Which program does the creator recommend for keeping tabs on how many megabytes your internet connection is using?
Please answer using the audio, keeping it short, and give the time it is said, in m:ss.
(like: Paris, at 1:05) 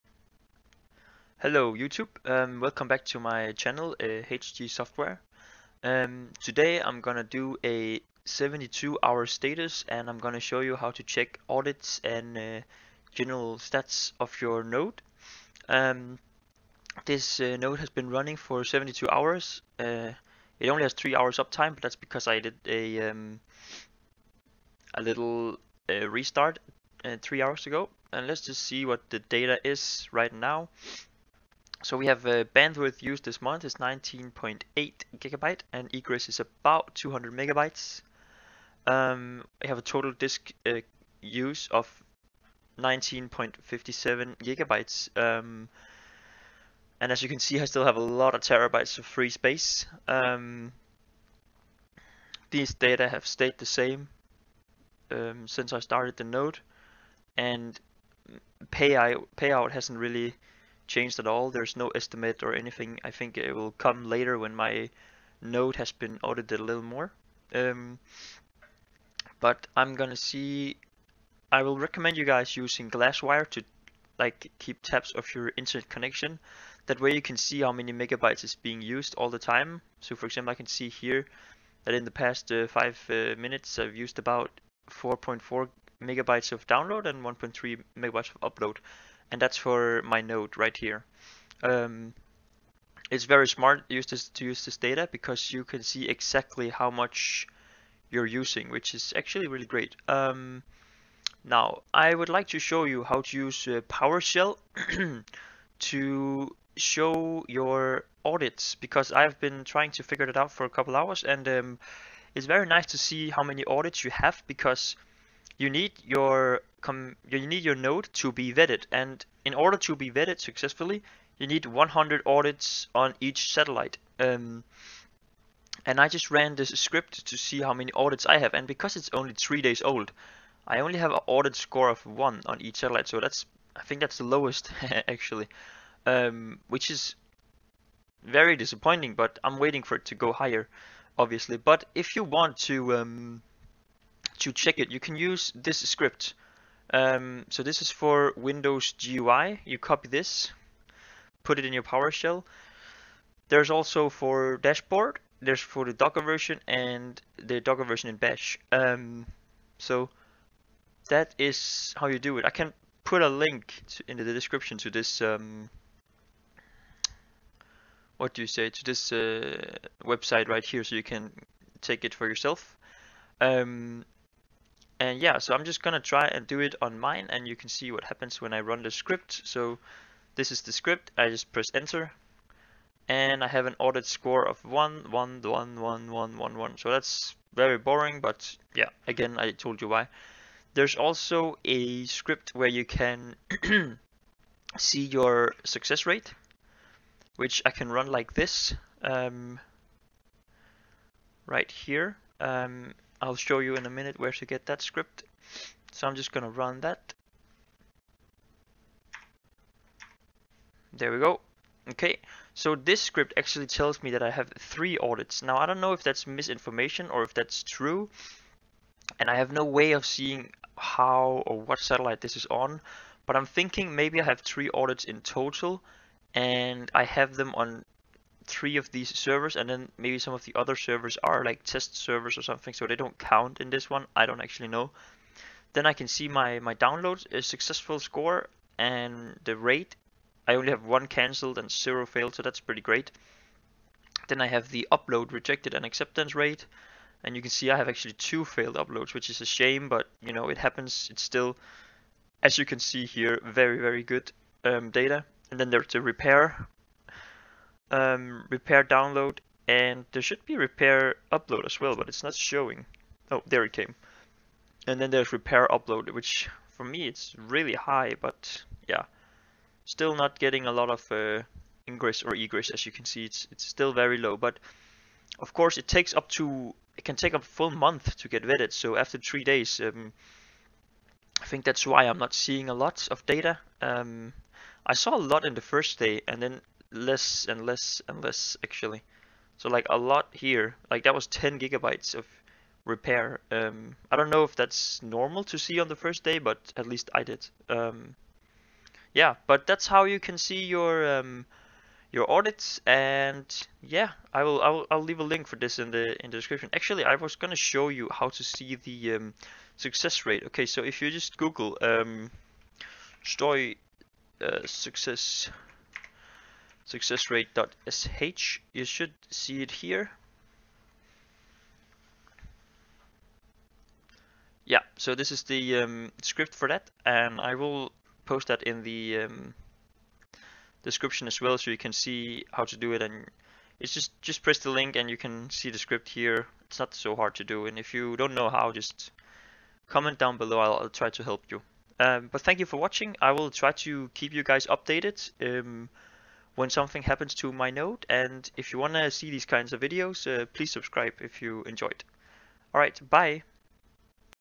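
Glasswire, at 1:12.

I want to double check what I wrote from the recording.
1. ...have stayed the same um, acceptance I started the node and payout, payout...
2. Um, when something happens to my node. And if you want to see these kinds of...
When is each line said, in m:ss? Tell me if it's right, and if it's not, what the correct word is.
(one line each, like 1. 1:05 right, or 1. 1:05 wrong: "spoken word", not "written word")
1. 0:53 wrong: "since", not "acceptance"
2. 5:45 right.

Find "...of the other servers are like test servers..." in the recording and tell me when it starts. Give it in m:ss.
3:50.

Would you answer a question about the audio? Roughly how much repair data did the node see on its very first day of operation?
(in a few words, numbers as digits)
10 GB.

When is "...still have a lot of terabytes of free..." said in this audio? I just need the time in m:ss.
0:47.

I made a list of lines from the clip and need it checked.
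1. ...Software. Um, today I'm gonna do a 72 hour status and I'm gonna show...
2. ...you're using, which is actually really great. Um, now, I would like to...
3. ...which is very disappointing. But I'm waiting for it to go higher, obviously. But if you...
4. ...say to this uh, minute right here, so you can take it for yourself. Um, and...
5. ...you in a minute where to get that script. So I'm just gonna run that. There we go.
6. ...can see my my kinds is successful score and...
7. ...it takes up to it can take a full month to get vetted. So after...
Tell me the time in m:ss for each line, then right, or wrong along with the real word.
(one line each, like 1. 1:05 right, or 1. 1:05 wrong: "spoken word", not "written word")
1. 0:04 right
2. 1:38 right
3. 2:16 right
4. 2:48 wrong: "website", not "minute"
5. 3:23 right
6. 3:55 wrong: "downloads", not "kinds"
7. 4:35 right.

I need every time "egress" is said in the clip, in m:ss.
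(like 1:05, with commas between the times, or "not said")
0:35, 4:32.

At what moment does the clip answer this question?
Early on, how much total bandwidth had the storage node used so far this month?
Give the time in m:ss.
0:33.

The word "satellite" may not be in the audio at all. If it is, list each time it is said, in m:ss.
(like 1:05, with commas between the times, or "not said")
2:03, 2:12, 3:41.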